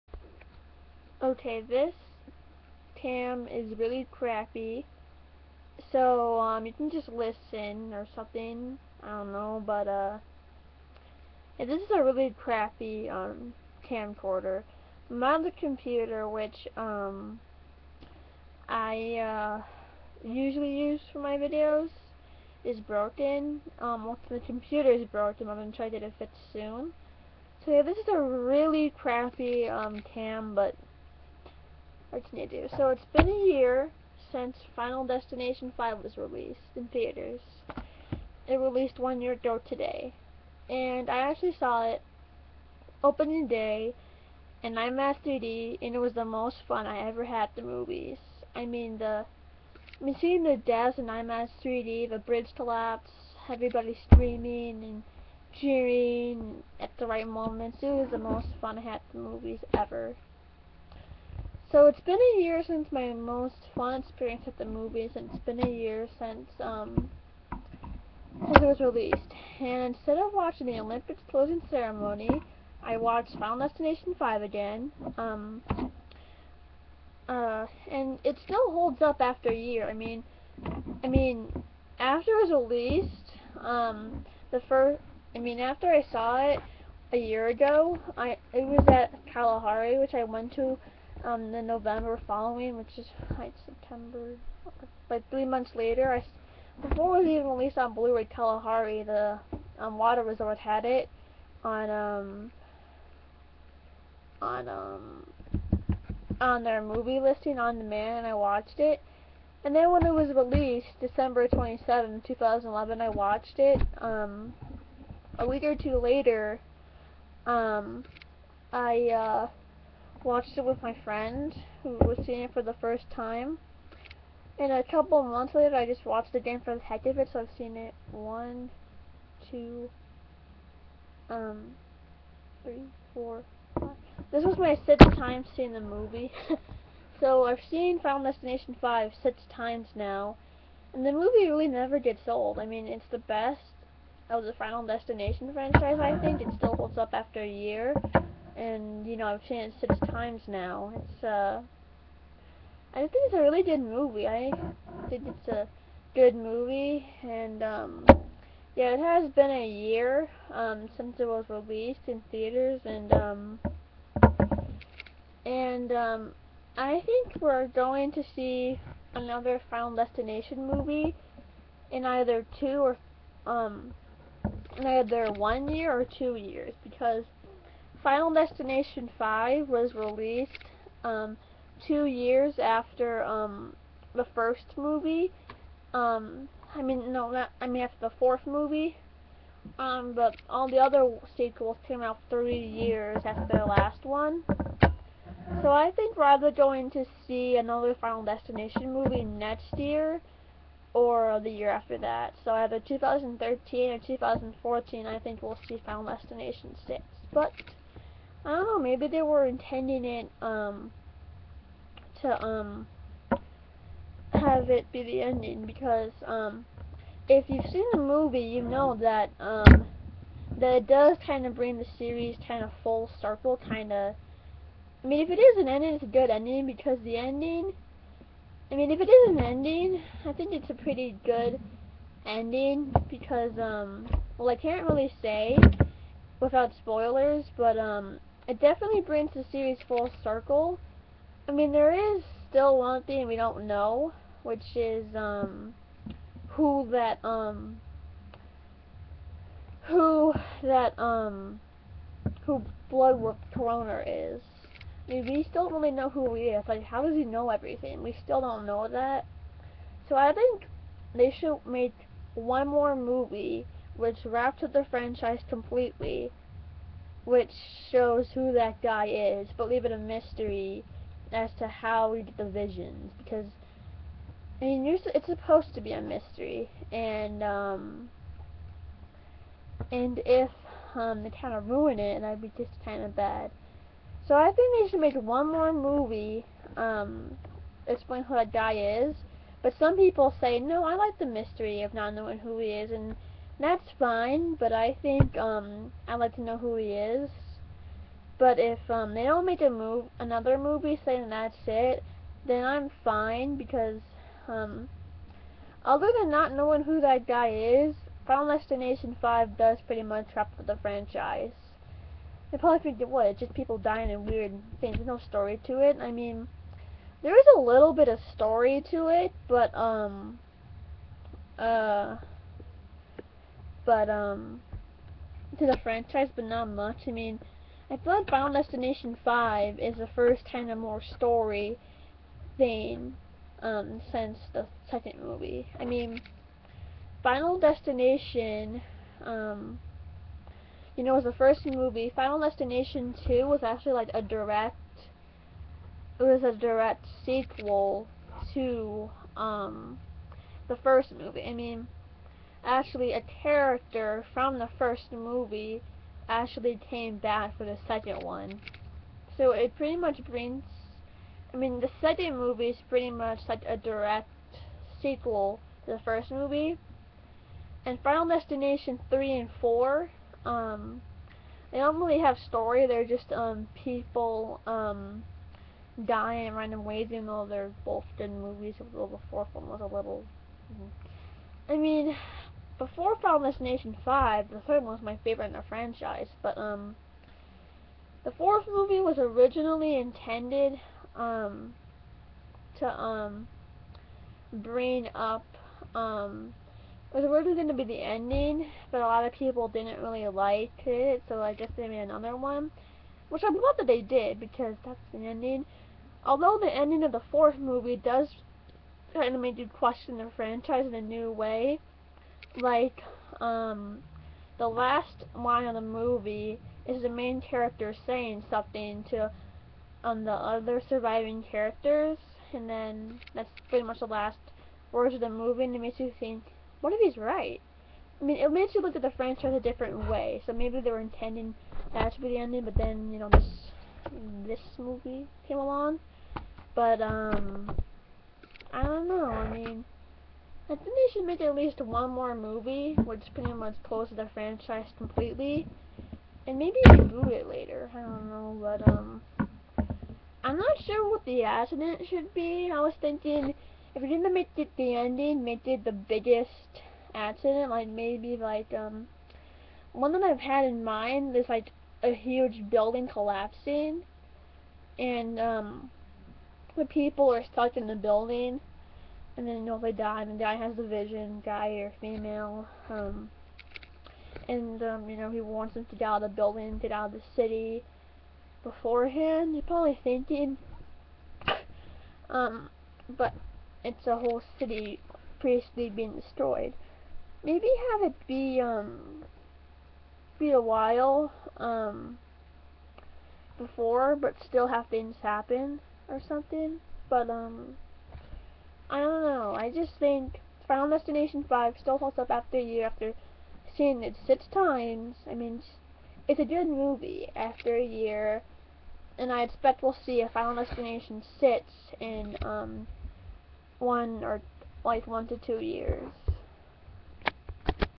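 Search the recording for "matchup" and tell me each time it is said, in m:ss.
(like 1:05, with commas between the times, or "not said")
not said.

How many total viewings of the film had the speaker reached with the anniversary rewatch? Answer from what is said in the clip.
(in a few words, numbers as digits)
6.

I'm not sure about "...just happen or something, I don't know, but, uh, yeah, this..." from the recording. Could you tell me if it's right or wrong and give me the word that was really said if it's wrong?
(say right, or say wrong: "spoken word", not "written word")
wrong: "listen", not "happen".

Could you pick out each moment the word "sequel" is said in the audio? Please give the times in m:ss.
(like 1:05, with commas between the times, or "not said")
3:11, 5:47, 6:05.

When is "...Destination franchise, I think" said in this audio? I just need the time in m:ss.
2:24.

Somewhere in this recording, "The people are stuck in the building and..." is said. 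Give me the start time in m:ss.
7:46.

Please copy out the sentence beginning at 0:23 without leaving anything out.
Um, well, the computer is broken.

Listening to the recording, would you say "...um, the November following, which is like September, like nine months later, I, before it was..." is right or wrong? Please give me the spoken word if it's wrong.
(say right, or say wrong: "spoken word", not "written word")
wrong: "three", not "nine".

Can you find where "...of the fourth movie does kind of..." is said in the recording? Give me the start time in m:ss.
6:47.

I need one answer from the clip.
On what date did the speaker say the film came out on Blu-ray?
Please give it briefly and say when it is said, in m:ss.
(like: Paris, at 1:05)
December 27, 2011, at 1:50.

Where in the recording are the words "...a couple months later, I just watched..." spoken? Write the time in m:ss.
2:04.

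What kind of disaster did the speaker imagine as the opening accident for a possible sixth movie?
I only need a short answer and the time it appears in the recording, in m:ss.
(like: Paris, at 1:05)
huge building collapsing, at 7:42.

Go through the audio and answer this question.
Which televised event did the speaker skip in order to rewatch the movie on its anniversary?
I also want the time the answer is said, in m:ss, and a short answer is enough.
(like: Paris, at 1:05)
Olympics closing ceremony, at 1:10.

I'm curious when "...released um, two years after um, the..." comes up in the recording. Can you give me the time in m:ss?
2:59.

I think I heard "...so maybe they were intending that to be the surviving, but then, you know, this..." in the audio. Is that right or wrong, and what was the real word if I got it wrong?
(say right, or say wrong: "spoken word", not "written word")
wrong: "ending", not "surviving".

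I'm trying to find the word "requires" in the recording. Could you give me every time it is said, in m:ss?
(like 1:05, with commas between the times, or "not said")
not said.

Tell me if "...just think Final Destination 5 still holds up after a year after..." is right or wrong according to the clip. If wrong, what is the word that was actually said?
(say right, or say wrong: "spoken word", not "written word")
right.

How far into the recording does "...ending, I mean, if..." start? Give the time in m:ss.
3:47.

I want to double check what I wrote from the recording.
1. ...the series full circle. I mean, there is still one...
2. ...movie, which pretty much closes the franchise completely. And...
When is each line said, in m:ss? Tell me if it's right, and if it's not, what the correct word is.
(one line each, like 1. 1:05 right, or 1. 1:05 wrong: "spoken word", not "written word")
1. 3:59 right
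2. 7:22 right.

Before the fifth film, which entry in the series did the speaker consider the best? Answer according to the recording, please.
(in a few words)
the third one.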